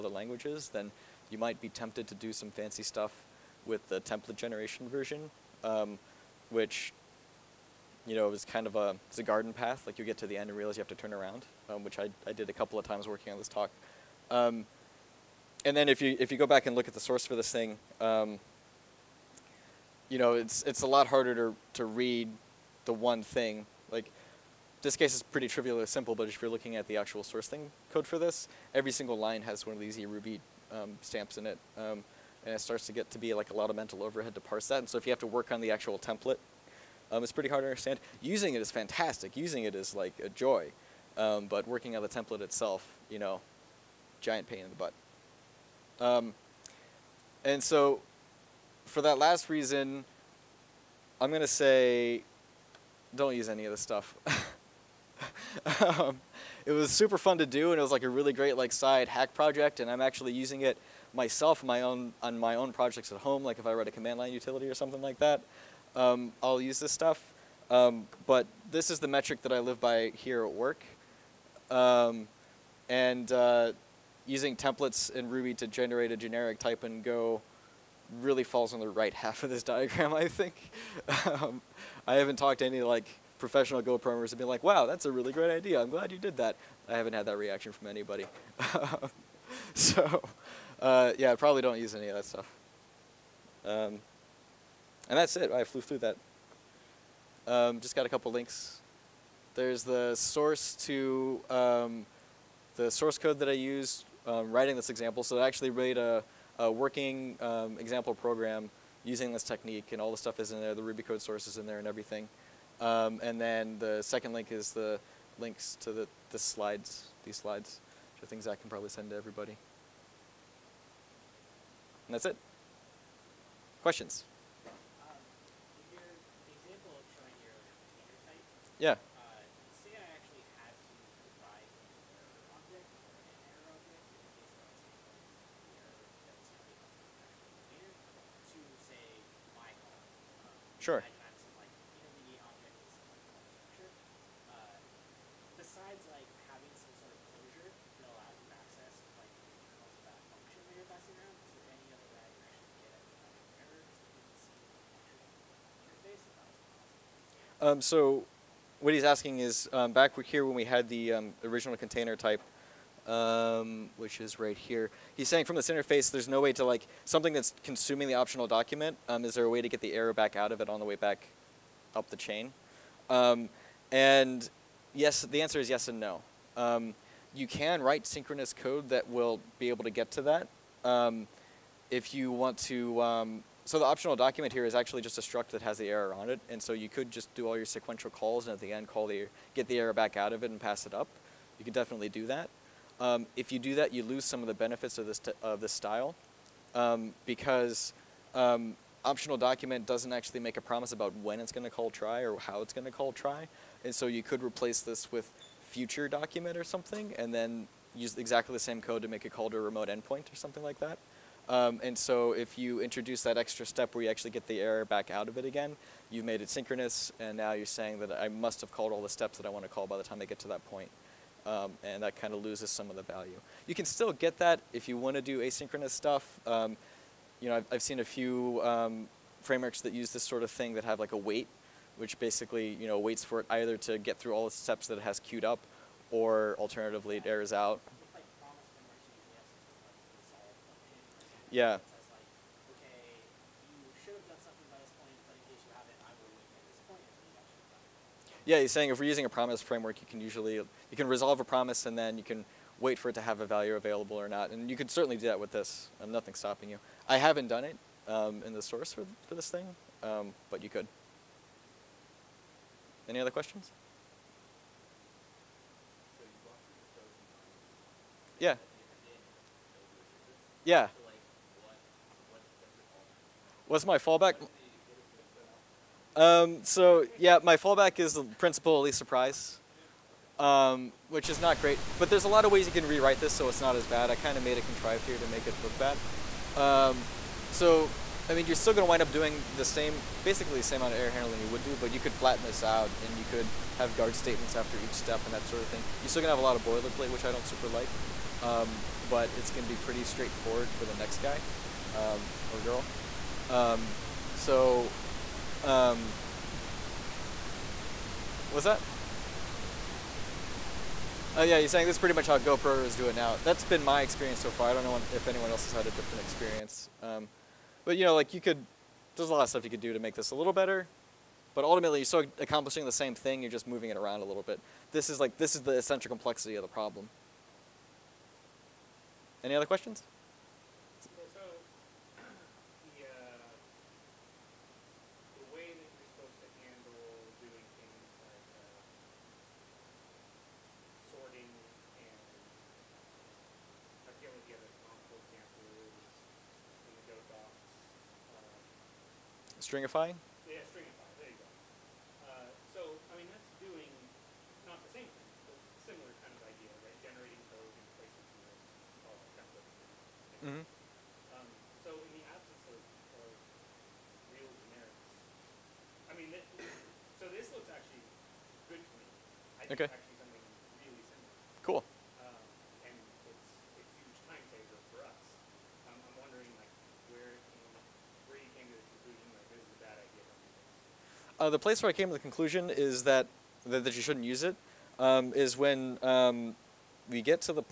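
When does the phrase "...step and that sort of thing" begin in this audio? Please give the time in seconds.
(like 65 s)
294 s.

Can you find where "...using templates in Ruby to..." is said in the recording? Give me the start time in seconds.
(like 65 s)
74 s.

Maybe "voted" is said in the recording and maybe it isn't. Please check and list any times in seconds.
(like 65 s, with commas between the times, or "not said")
not said.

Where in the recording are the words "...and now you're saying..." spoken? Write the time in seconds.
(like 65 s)
217 s.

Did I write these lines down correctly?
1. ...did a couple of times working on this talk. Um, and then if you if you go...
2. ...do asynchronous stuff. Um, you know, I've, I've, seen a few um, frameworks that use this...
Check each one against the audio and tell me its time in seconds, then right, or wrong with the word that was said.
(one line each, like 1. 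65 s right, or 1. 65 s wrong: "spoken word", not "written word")
1. 12 s right
2. 225 s right.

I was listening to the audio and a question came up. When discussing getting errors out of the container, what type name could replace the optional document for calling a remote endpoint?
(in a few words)
future document.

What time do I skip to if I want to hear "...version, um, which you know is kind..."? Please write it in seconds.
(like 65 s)
4 s.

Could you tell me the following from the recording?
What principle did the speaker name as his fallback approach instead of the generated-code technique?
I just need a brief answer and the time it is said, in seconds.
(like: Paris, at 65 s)
principle of least surprise, at 278 s.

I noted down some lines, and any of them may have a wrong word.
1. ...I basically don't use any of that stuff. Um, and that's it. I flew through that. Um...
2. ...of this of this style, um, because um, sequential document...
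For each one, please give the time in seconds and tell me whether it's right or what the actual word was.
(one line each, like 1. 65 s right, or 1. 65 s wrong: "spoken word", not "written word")
1. 91 s wrong: "probably", not "basically"
2. 194 s wrong: "optional", not "sequential".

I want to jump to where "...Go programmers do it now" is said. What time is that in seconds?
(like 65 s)
312 s.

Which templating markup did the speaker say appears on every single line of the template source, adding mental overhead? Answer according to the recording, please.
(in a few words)
eRuby.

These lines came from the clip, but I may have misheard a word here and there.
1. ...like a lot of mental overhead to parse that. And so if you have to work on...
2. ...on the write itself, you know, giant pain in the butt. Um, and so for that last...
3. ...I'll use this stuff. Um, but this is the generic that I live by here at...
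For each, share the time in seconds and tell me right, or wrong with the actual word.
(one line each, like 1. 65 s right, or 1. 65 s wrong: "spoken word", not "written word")
1. 33 s right
2. 41 s wrong: "template", not "write"
3. 66 s wrong: "metric", not "generic".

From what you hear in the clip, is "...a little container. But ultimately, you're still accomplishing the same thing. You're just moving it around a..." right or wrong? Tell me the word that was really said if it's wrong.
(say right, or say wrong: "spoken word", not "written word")
wrong: "better", not "container".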